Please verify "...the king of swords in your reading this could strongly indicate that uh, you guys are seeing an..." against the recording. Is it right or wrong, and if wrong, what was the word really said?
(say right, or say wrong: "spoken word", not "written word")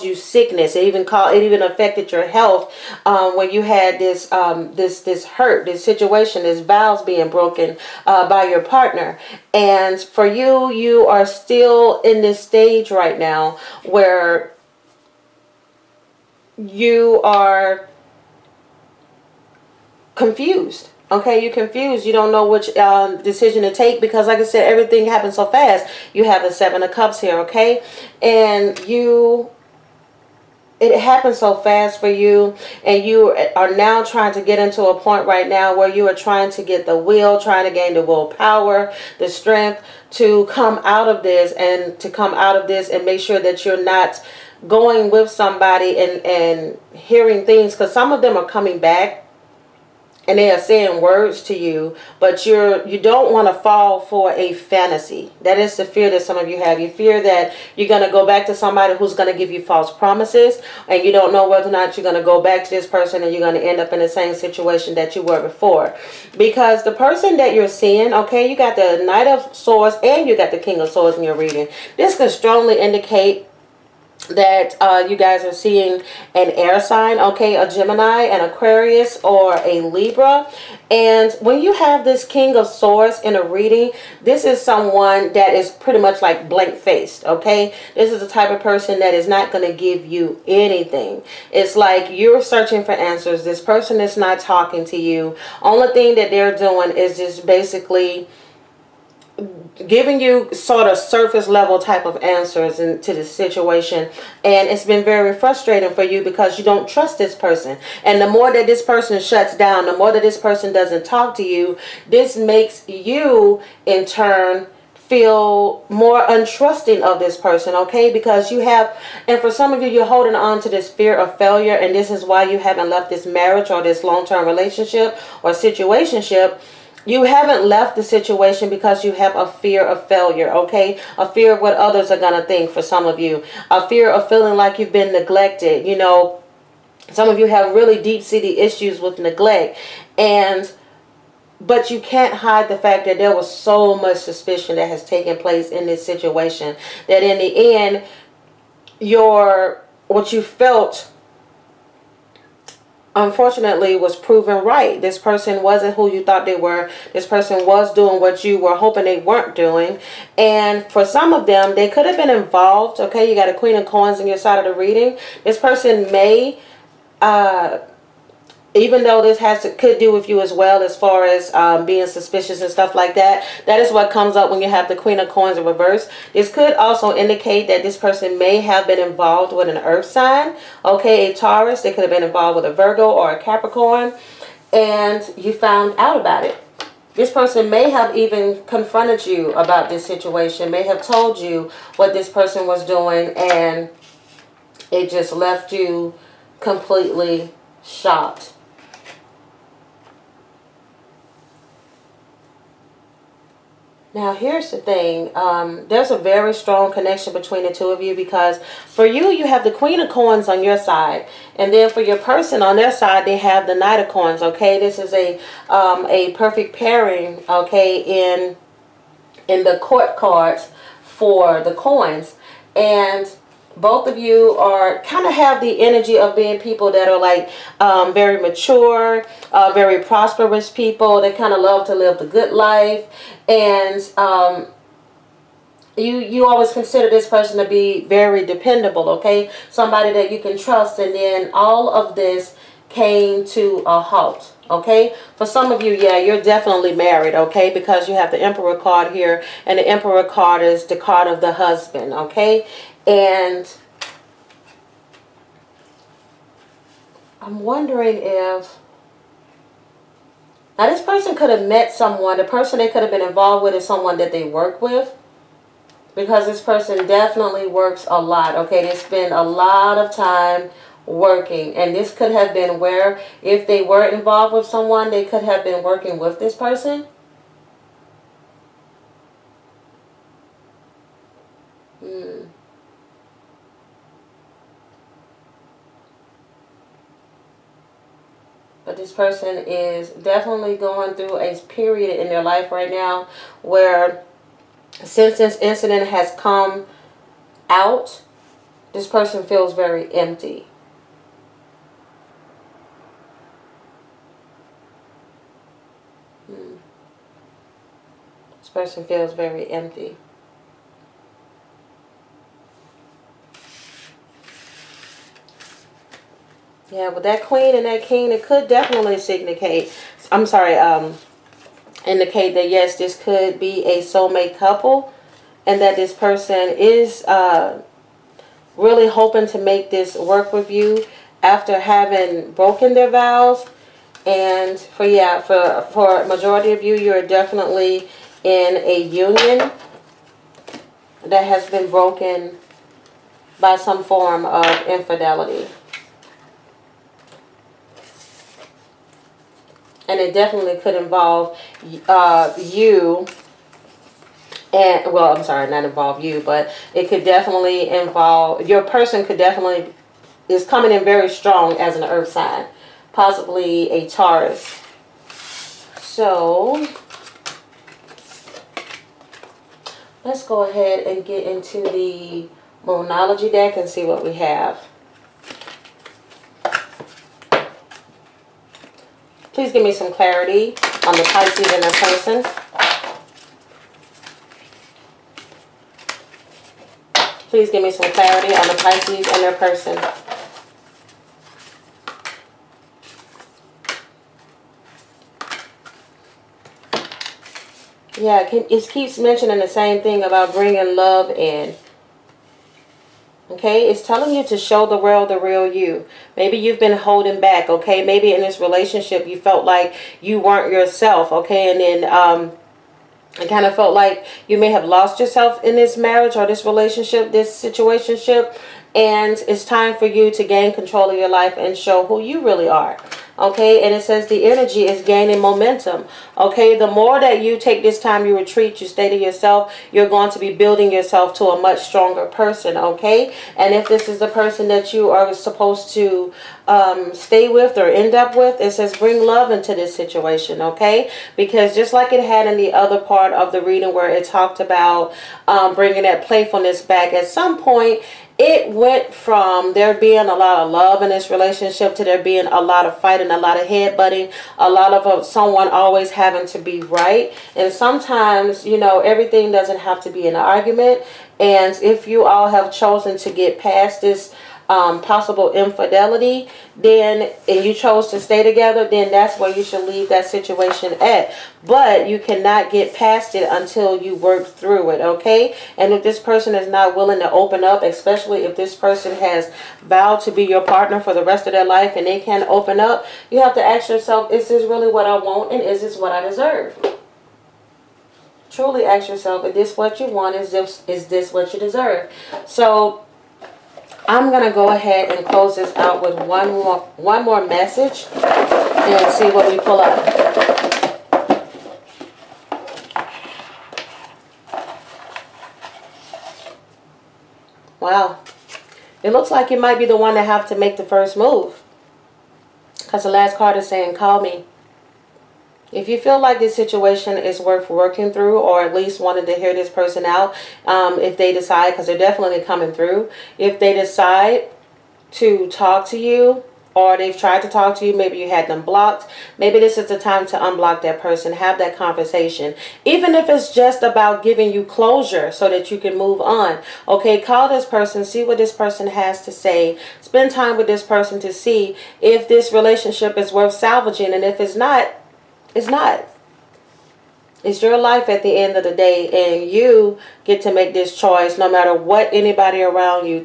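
right.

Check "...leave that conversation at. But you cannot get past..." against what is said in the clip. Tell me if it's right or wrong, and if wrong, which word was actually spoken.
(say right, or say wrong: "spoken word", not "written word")
wrong: "situation", not "conversation".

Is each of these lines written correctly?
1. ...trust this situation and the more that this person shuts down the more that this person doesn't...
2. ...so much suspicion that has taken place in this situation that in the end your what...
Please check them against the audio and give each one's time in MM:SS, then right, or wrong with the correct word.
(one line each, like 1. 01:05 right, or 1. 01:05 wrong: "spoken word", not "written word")
1. 01:46 wrong: "person", not "situation"
2. 02:23 right.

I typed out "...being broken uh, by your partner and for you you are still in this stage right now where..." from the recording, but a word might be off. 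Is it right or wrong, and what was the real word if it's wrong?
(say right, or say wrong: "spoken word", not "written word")
right.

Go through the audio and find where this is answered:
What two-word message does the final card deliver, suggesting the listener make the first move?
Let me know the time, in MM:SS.
08:33.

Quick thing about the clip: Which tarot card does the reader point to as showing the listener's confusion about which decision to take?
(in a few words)
Seven of Cups.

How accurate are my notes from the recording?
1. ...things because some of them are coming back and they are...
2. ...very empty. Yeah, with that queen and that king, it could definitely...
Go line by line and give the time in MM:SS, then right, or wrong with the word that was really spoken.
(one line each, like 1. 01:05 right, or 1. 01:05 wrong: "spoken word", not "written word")
1. 00:47 right
2. 05:09 right.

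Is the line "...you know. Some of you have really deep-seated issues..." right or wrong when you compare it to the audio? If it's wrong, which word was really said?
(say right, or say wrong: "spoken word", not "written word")
right.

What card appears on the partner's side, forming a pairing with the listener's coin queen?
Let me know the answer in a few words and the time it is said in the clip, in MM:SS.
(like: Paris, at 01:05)
Knight of Coins, at 03:33.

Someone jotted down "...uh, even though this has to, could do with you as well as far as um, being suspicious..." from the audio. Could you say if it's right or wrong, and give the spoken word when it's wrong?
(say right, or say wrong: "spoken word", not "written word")
right.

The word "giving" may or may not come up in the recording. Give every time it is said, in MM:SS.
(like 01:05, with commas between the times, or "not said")
01:39, 08:54.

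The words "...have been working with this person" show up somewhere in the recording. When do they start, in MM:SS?
04:35.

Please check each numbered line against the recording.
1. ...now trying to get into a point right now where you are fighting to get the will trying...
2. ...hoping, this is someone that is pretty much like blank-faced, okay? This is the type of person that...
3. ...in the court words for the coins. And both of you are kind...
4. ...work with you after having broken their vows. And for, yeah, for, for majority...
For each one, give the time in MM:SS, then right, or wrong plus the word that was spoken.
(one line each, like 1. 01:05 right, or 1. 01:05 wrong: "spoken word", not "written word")
1. 00:33 wrong: "trying", not "fighting"
2. 01:23 wrong: "reading", not "hoping"
3. 03:39 wrong: "cards", not "words"
4. 05:30 right.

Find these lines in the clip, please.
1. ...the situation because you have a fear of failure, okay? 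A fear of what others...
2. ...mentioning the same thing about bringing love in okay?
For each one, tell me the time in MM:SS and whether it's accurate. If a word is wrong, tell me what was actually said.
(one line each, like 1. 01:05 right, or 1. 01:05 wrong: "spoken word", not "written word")
1. 02:07 right
2. 06:39 right.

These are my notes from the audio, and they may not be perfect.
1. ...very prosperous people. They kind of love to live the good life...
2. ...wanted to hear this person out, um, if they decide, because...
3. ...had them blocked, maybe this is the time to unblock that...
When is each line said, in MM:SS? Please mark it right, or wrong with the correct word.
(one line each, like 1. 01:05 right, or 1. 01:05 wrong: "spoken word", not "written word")
1. 03:49 right
2. 08:38 right
3. 08:48 right.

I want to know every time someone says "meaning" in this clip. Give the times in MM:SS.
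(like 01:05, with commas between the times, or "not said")
not said.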